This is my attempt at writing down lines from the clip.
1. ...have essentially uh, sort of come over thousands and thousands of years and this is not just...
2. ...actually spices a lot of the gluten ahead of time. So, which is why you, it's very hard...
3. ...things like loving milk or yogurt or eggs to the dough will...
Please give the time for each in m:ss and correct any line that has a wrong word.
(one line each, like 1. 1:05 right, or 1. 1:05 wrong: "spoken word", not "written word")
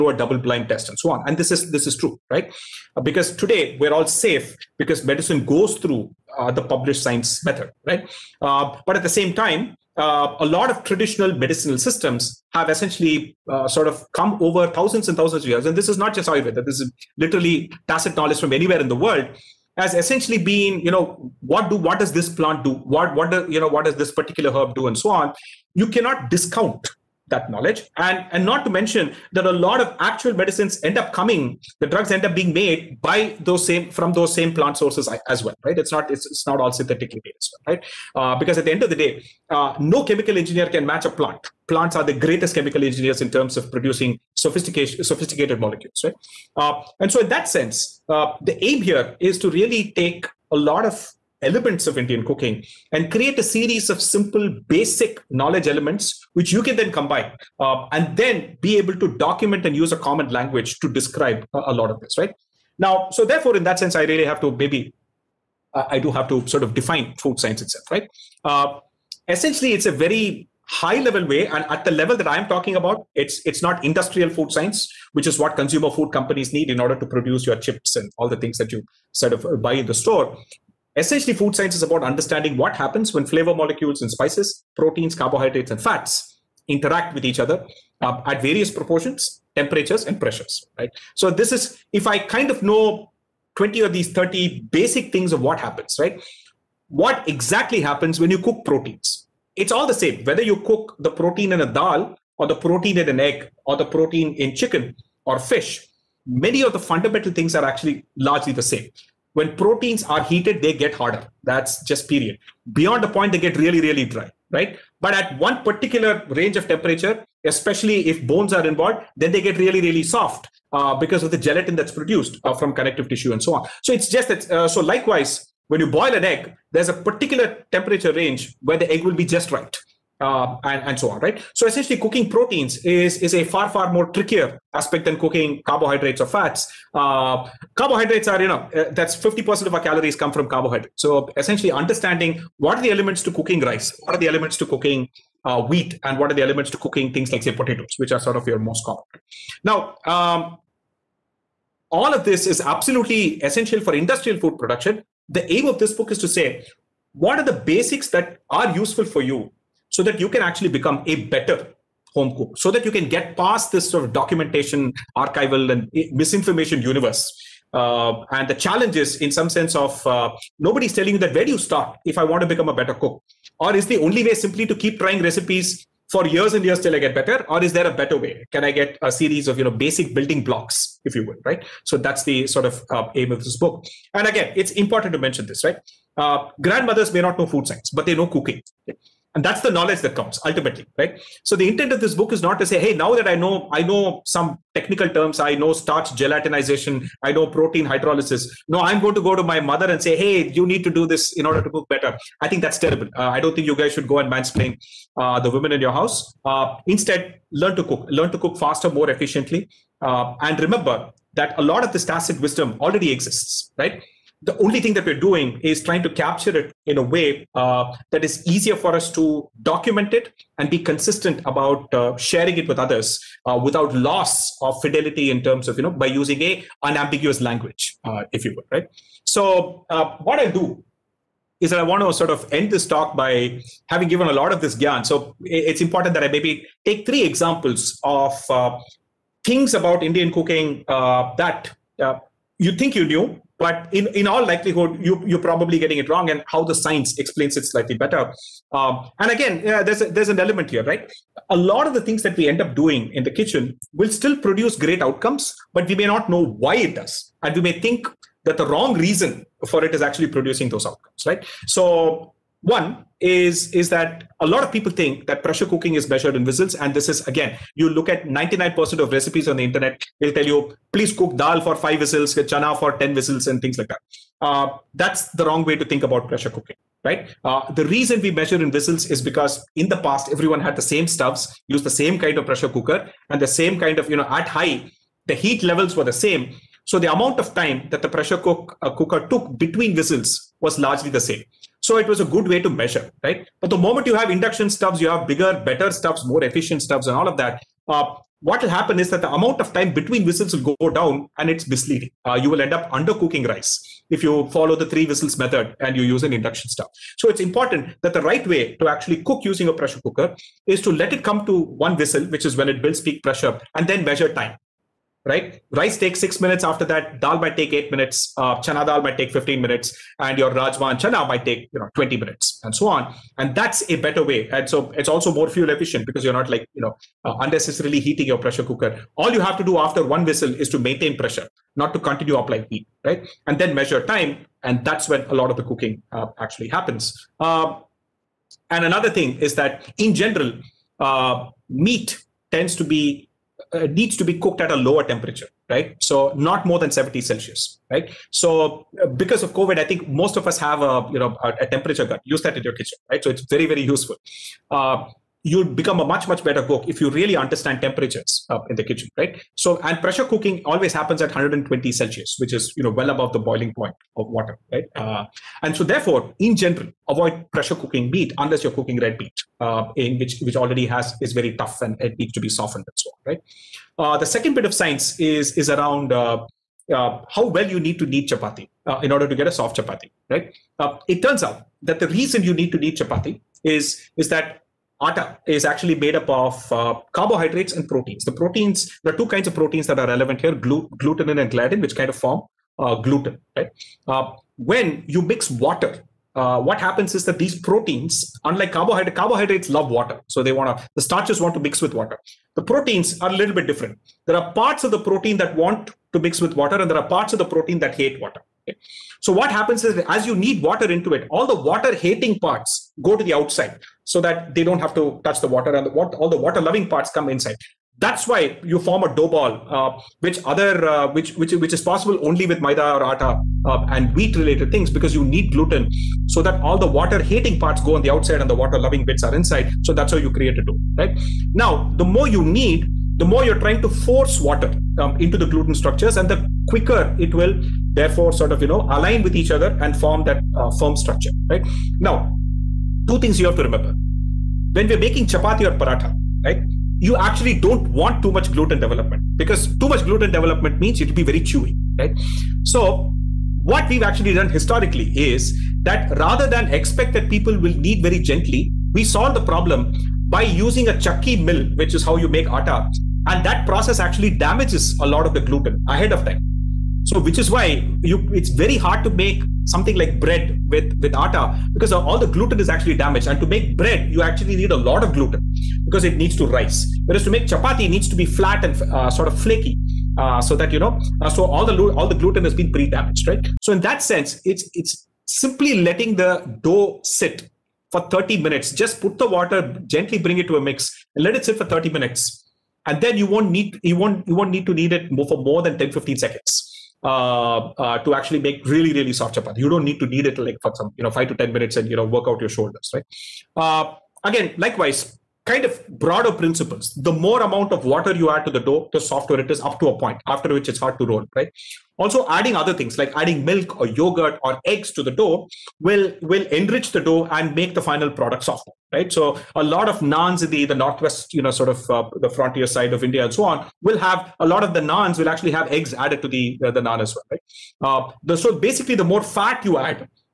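1. 0:12 right
2. 7:43 wrong: "damages", not "spices"
3. 8:32 wrong: "adding", not "loving".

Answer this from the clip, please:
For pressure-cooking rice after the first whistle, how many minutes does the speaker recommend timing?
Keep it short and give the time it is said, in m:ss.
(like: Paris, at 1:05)
6 minutes, at 5:16.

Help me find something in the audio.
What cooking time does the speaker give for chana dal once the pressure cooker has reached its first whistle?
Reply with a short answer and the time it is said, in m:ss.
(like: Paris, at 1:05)
15 minutes, at 5:19.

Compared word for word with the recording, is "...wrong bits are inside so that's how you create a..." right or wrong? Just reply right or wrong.
wrong.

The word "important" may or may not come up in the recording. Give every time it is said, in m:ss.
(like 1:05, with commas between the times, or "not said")
3:04, 3:55, 5:07.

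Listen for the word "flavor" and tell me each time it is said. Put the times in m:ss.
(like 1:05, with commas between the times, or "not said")
1:23.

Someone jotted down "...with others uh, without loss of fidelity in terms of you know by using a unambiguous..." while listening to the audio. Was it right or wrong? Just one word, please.
right.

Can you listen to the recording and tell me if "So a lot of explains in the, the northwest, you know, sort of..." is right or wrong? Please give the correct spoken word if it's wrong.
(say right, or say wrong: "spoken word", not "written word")
wrong: "naans", not "explains".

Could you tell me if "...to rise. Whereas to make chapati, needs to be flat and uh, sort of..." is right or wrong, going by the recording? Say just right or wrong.
right.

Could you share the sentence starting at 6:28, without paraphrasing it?
The proteins, there are two kinds of proteins that are relevant here: glu- and gliadin, which kind of form uh, gluten, right?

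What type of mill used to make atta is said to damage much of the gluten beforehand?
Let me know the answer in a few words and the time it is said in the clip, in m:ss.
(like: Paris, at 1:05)
Chakki mill, at 7:40.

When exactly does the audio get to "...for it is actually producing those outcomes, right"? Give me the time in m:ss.
4:19.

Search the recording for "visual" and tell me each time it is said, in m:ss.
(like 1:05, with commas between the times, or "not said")
not said.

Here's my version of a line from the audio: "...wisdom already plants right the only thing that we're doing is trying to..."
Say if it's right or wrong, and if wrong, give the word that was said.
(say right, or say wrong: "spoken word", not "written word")
wrong: "exists", not "plants".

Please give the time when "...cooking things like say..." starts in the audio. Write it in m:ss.
2:26.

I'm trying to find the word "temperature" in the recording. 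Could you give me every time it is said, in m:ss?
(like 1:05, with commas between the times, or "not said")
1:29, 1:56, 2:07, 5:45, 5:51, 5:57.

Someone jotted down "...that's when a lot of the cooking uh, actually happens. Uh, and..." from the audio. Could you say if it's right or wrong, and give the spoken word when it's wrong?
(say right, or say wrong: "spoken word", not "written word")
right.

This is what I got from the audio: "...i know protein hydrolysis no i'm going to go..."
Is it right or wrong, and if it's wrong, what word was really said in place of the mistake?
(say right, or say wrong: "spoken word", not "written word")
right.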